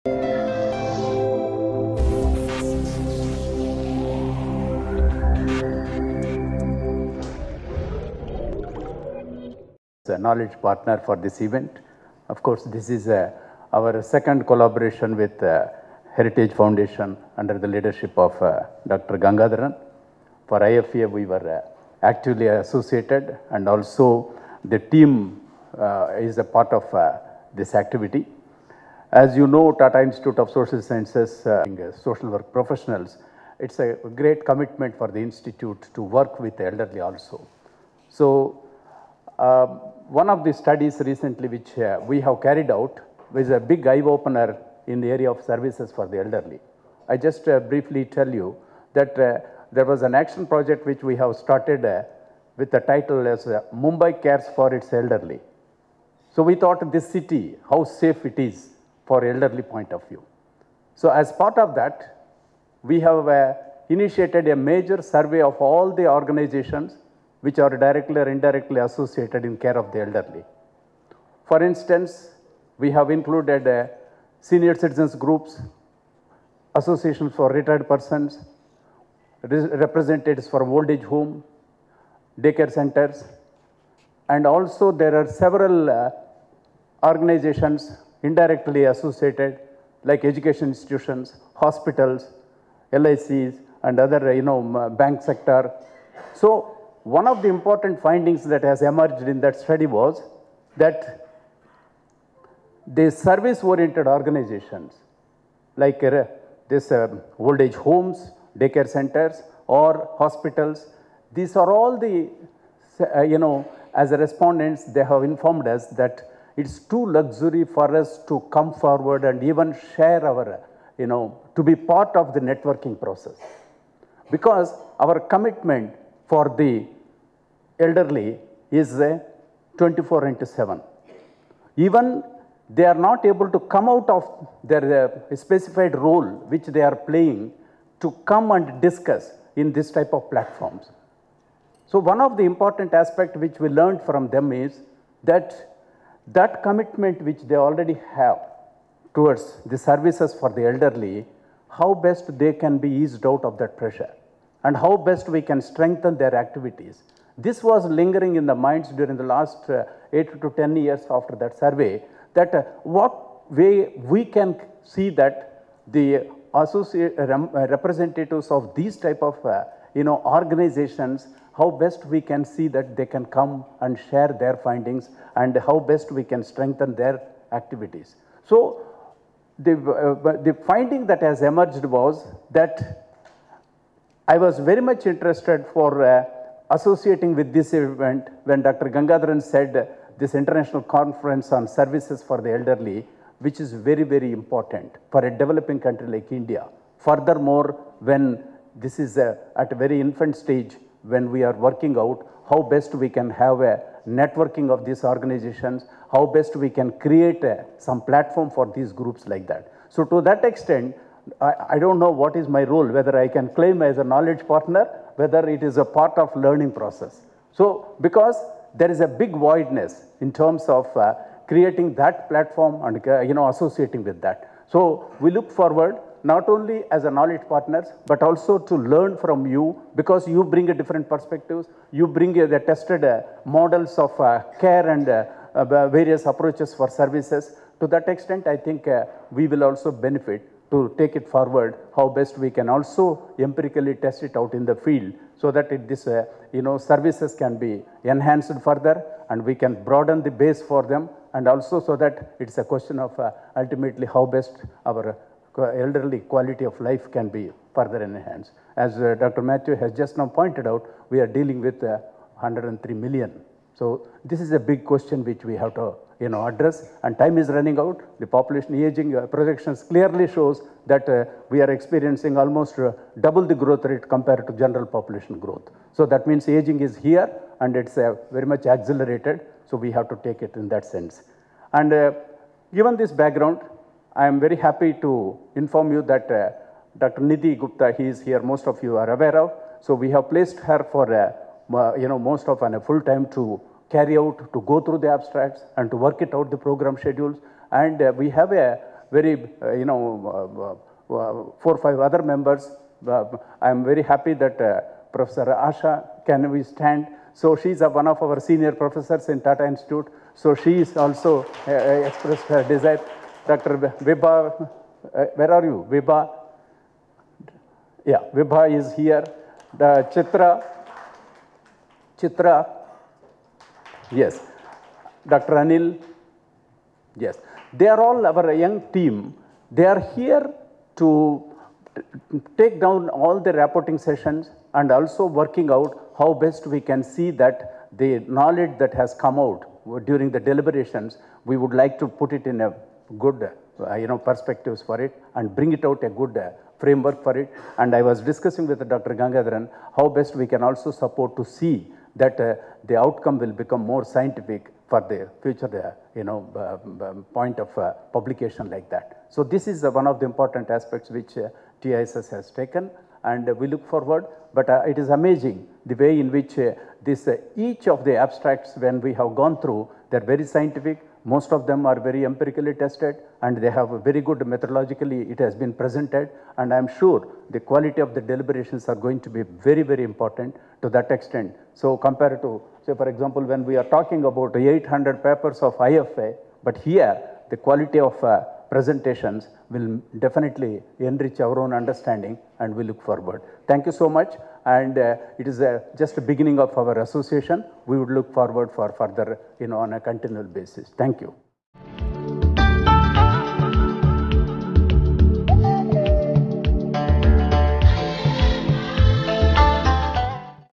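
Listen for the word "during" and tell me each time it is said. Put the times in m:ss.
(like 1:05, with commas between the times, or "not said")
2:38, 5:40.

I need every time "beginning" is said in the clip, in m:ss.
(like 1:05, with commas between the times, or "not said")
6:36.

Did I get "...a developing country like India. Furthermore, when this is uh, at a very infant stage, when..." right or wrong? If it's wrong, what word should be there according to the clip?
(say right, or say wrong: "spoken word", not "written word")
right.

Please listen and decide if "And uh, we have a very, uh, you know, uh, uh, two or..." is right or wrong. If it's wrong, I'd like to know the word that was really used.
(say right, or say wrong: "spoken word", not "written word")
wrong: "four", not "two".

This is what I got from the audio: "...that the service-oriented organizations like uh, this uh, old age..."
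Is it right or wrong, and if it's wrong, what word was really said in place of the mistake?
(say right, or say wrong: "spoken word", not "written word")
right.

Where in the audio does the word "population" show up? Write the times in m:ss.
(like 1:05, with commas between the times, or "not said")
4:28, 4:34.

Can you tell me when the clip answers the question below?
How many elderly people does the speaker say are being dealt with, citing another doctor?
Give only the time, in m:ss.
4:21.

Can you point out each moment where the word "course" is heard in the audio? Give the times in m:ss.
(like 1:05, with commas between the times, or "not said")
0:12.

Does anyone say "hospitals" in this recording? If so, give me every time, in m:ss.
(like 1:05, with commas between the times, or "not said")
1:31, 1:50.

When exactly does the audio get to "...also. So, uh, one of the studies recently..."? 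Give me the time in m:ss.
0:36.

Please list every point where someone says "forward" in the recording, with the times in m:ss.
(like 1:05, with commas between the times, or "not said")
1:58, 3:45, 4:01, 6:03, 6:33, 6:38.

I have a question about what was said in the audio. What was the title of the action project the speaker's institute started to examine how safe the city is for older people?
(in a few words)
Mumbai Cares for Its Elderly.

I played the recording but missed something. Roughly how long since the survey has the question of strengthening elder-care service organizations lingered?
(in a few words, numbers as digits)
8 to 10 years.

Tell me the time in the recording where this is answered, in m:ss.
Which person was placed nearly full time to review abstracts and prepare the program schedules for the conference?
4:46.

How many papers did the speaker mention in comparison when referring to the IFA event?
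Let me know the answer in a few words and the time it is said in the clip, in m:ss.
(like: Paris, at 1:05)
800, at 6:24.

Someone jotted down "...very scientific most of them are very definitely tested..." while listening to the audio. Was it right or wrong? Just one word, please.
wrong.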